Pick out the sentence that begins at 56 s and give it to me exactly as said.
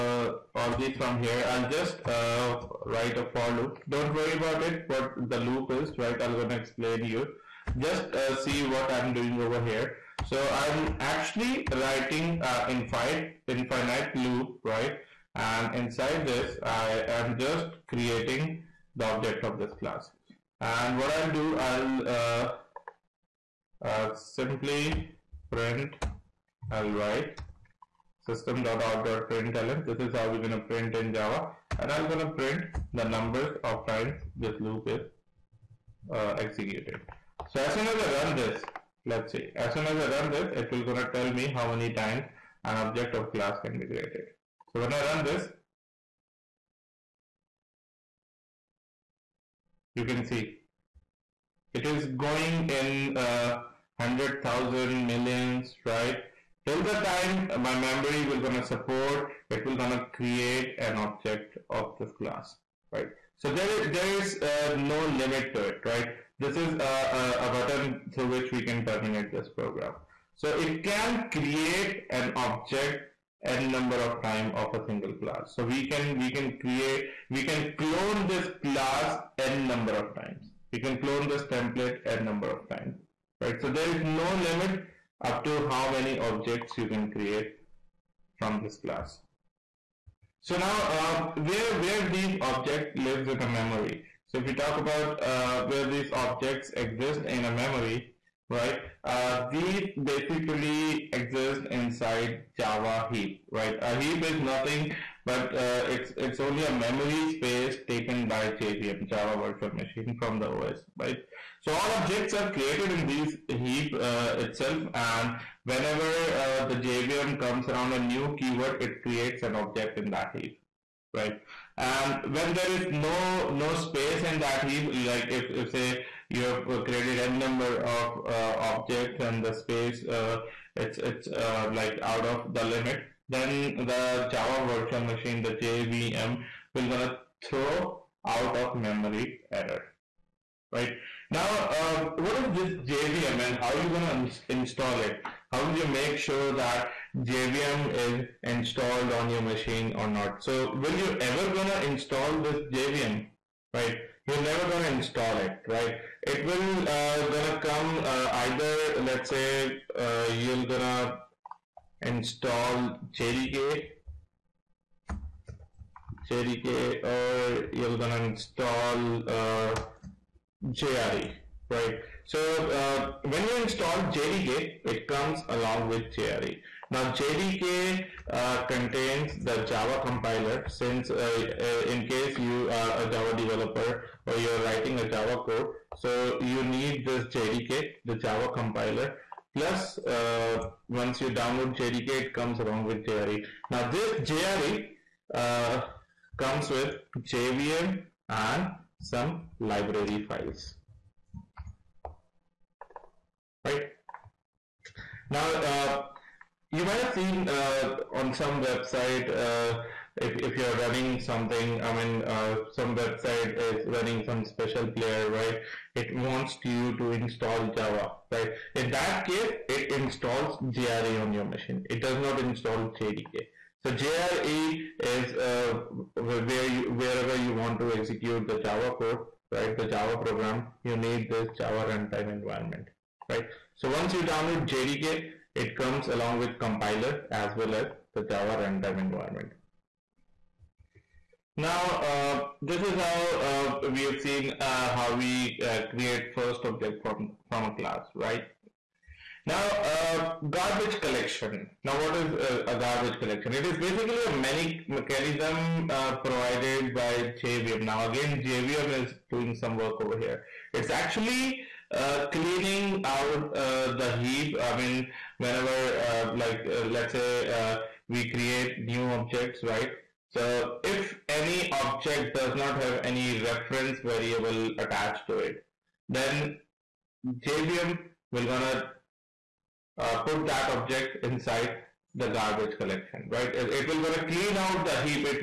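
Till the time my memory will gonna support, it will gonna create an object of this class, right?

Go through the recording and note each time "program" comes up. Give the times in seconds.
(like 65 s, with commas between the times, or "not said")
69 s, 230 s.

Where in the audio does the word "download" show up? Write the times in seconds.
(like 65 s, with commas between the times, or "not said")
191 s, 234 s.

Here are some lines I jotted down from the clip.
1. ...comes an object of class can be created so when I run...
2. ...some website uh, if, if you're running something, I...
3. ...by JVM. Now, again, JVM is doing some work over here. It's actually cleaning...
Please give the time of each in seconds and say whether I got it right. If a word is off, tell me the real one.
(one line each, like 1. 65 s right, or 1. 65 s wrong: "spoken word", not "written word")
1. 41 s wrong: "times", not "comes"
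2. 208 s right
3. 256 s right.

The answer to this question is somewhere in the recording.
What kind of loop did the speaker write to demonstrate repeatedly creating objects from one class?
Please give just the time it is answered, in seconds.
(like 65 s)
13 s.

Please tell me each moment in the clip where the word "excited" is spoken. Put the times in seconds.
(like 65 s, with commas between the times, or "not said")
not said.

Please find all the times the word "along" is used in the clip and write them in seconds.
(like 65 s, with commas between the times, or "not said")
175 s, 192 s, 236 s.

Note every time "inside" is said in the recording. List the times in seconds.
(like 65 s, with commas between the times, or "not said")
15 s, 101 s, 281 s.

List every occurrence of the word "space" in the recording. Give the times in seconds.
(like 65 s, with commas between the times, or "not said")
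107 s, 123 s, 129 s.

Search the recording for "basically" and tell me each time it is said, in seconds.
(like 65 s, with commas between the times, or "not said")
100 s, 253 s.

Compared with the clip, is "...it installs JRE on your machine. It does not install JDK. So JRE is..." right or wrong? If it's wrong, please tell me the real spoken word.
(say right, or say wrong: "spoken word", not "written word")
right.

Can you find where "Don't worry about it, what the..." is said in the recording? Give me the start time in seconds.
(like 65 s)
3 s.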